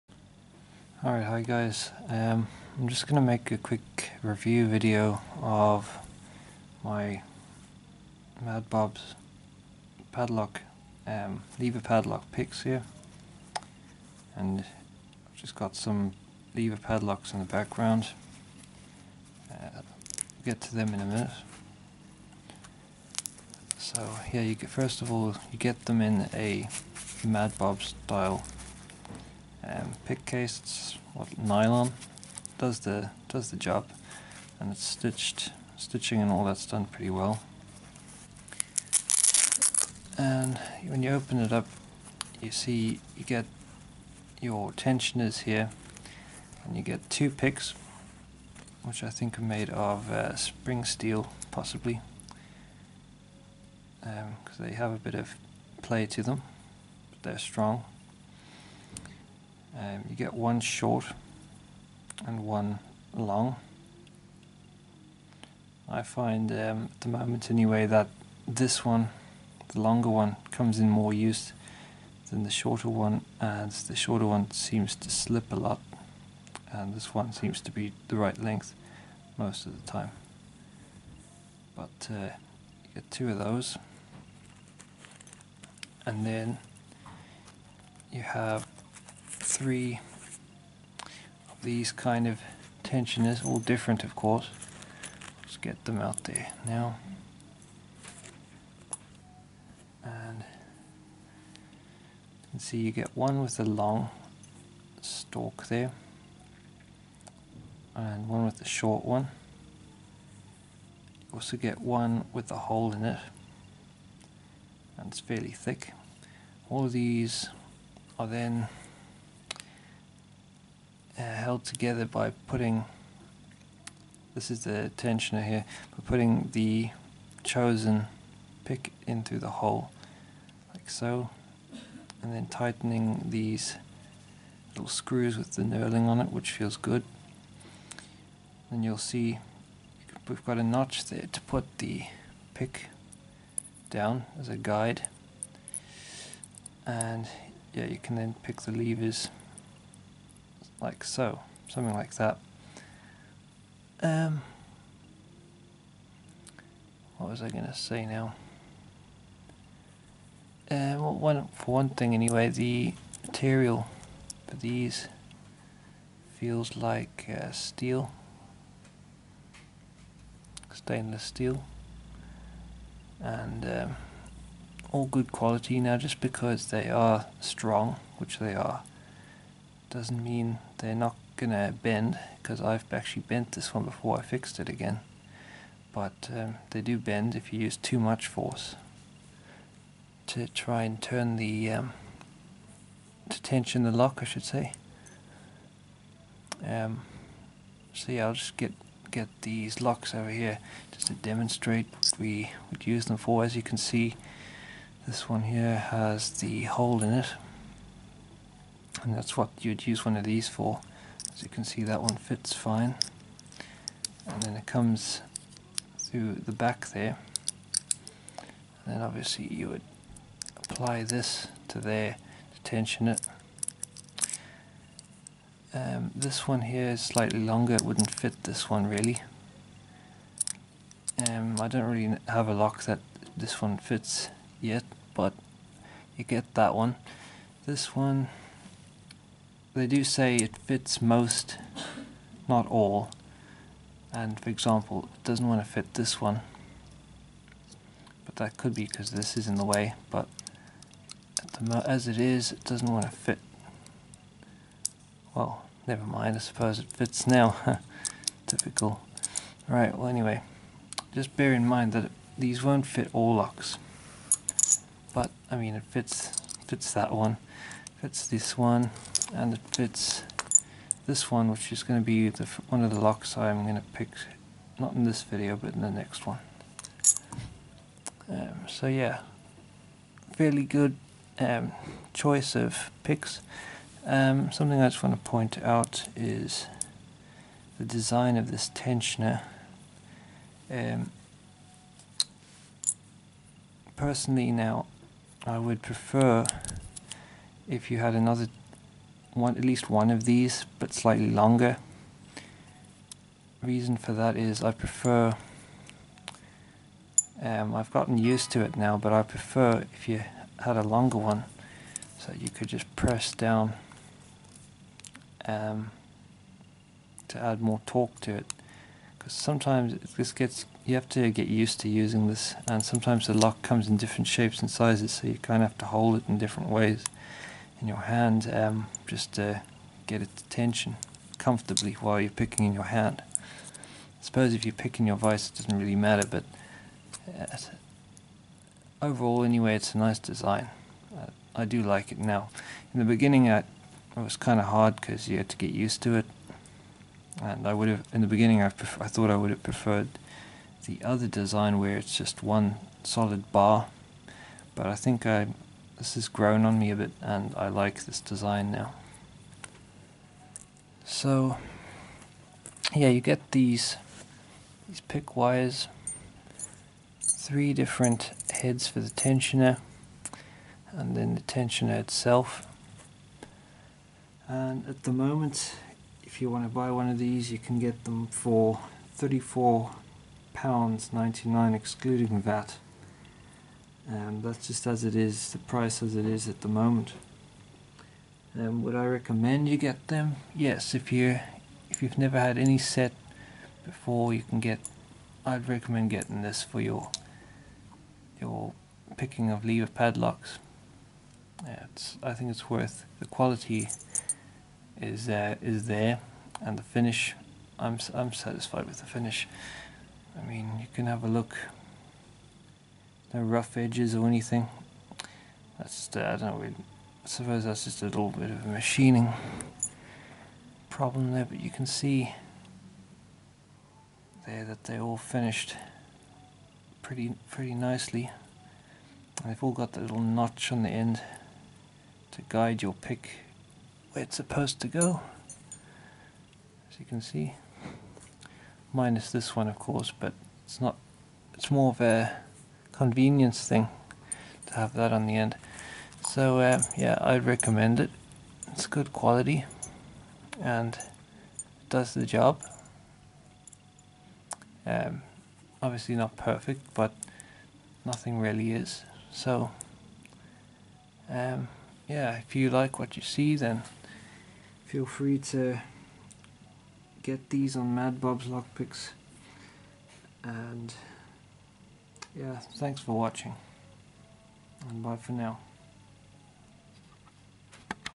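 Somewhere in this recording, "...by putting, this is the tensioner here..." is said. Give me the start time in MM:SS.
02:02.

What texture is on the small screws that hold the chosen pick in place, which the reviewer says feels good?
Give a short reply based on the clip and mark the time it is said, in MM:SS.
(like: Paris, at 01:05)
Knurling, at 02:15.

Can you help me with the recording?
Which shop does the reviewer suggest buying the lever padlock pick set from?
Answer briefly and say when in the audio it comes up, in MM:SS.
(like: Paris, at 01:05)
Madbob's Lockpicks, at 07:47.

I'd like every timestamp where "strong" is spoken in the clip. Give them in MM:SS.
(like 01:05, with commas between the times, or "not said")
00:57, 02:57.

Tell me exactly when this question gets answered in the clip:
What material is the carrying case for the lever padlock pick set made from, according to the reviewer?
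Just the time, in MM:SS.
00:31.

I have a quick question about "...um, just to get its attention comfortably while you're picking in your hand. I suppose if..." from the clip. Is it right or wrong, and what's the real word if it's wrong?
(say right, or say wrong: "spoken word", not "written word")
right.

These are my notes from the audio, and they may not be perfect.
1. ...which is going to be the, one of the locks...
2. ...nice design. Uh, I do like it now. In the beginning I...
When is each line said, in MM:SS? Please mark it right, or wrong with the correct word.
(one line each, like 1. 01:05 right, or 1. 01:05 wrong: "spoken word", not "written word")
1. 04:31 right
2. 05:39 right.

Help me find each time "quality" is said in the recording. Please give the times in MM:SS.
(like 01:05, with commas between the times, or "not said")
02:55, 06:43, 07:29.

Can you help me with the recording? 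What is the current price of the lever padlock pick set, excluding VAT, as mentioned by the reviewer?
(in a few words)
£34.99.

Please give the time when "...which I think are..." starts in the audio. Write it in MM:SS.
00:48.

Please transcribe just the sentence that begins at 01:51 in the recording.
You also get one with a hole in it and it's fairly thick.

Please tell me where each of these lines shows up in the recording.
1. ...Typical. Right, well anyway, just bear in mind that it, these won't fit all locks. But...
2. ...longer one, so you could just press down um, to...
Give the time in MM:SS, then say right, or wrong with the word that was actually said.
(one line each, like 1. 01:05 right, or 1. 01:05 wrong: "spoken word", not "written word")
1. 04:18 right
2. 05:10 right.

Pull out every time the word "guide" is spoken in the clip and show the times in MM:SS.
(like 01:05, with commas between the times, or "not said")
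02:24, 07:12.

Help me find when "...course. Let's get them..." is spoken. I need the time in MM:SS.
01:34.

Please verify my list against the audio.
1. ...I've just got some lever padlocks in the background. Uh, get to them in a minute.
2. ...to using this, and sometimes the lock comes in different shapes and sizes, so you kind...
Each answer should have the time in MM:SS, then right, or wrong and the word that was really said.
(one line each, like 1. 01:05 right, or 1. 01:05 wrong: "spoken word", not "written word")
1. 00:14 right
2. 05:21 right.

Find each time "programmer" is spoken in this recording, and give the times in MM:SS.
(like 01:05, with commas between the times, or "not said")
not said.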